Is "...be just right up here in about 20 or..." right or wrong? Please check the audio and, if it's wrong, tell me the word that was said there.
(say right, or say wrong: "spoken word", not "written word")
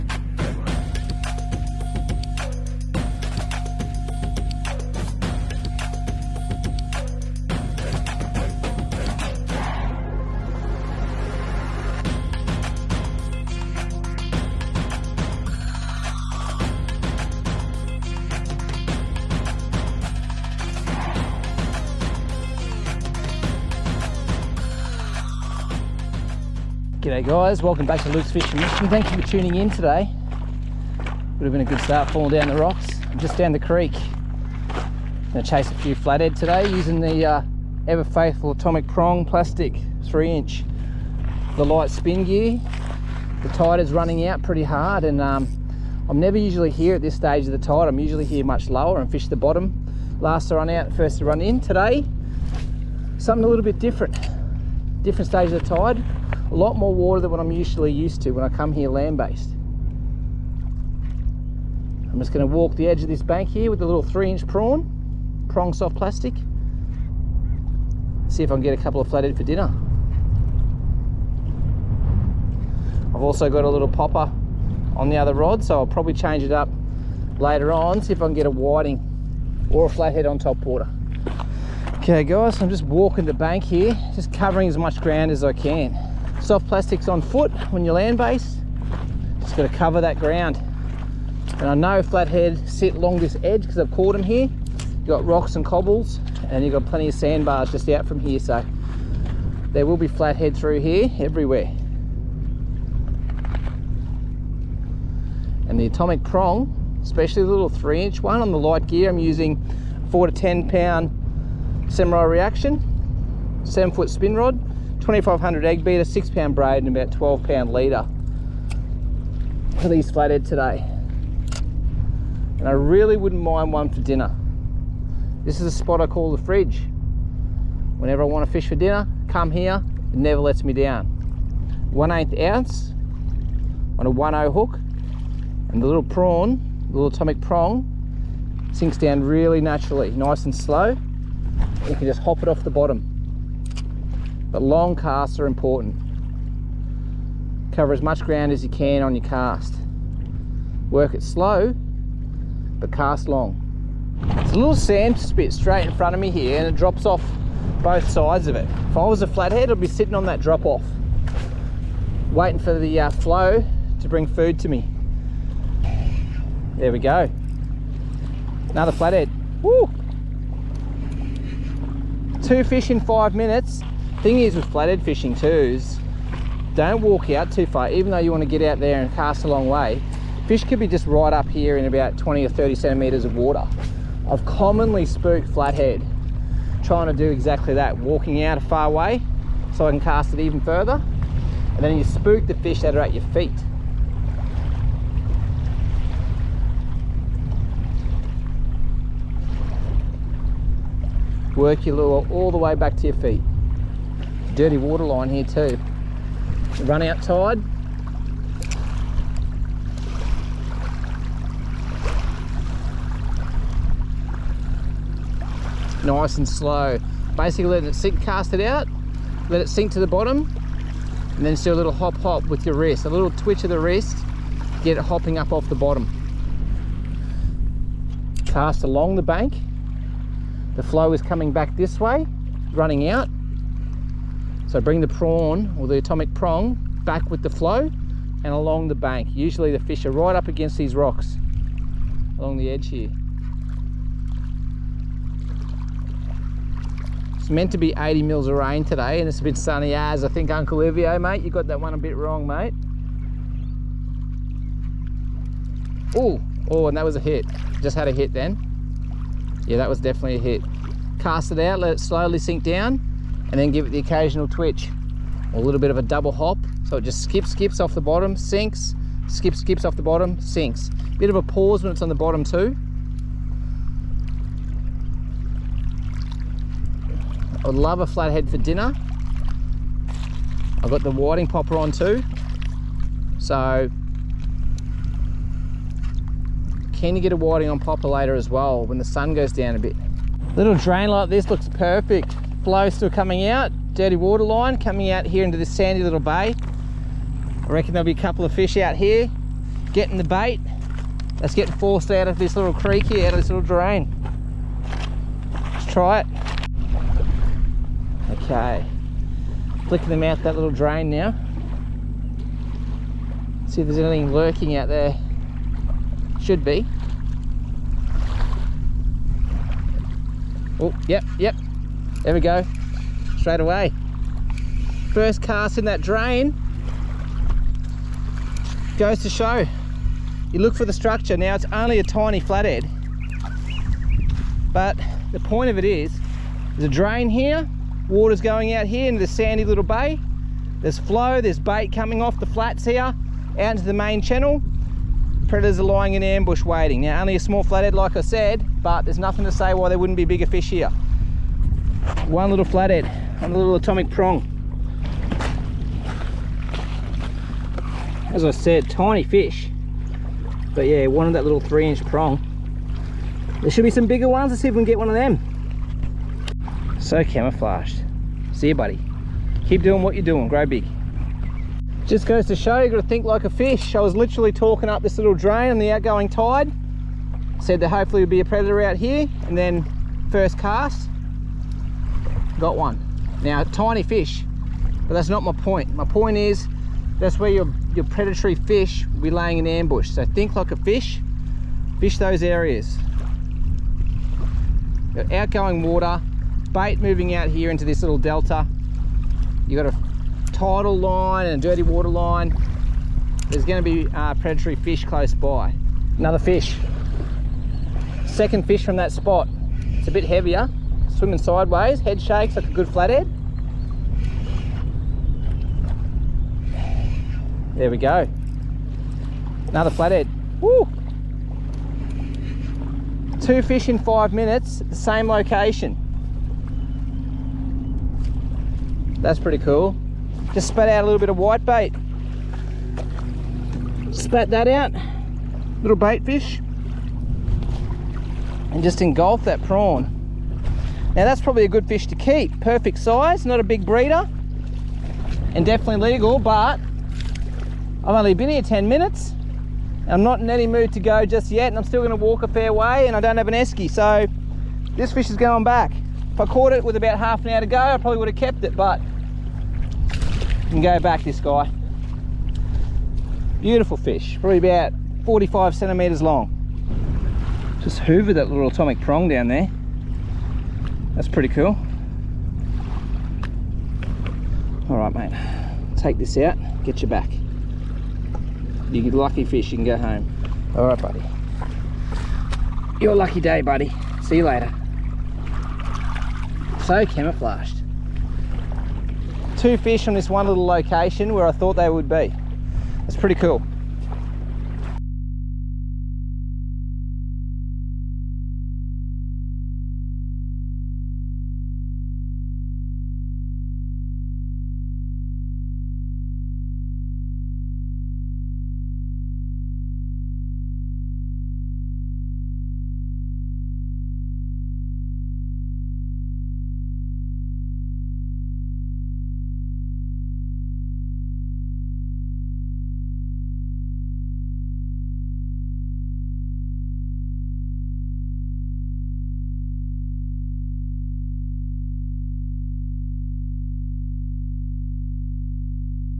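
right.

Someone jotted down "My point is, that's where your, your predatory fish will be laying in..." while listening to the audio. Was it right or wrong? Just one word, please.
right.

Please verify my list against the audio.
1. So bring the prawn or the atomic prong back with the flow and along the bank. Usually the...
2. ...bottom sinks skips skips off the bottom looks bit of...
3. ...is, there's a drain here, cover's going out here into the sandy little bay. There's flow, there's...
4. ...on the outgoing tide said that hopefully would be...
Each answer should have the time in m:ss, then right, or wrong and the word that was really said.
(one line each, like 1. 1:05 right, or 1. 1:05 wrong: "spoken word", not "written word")
1. 3:54 right
2. 4:28 wrong: "sinks", not "looks"
3. 5:35 wrong: "water", not "cover"
4. 6:15 right.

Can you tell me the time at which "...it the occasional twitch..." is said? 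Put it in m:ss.
4:23.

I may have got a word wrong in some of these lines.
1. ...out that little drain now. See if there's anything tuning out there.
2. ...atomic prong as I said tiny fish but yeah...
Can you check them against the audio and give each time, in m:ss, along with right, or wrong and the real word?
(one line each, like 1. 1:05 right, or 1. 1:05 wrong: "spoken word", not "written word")
1. 5:10 wrong: "lurking", not "tuning"
2. 5:53 right.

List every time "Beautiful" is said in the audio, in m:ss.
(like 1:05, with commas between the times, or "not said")
7:43.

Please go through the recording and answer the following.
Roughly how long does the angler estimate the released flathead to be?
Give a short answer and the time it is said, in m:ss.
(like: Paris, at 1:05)
45 centimeters, at 7:45.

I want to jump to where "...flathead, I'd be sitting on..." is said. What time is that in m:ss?
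2:39.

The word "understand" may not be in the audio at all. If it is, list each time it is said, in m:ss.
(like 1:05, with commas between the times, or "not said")
not said.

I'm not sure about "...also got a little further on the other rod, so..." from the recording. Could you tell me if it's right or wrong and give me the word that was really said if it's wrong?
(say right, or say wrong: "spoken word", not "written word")
wrong: "popper", not "further".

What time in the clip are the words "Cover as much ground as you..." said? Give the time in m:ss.
2:27.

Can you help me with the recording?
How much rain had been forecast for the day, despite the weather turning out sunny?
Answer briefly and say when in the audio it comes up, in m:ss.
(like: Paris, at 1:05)
80 mils, at 4:07.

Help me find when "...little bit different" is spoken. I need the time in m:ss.
0:53.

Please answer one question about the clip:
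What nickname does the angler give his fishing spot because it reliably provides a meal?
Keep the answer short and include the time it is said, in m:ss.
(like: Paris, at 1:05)
the fridge, at 2:06.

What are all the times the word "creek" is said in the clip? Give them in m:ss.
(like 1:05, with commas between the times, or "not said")
0:33, 5:02.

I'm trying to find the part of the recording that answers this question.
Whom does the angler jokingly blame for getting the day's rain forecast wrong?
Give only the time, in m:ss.
4:10.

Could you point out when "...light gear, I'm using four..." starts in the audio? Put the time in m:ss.
1:48.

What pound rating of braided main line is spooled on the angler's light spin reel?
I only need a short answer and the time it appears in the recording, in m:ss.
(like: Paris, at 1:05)
6 pound, at 1:56.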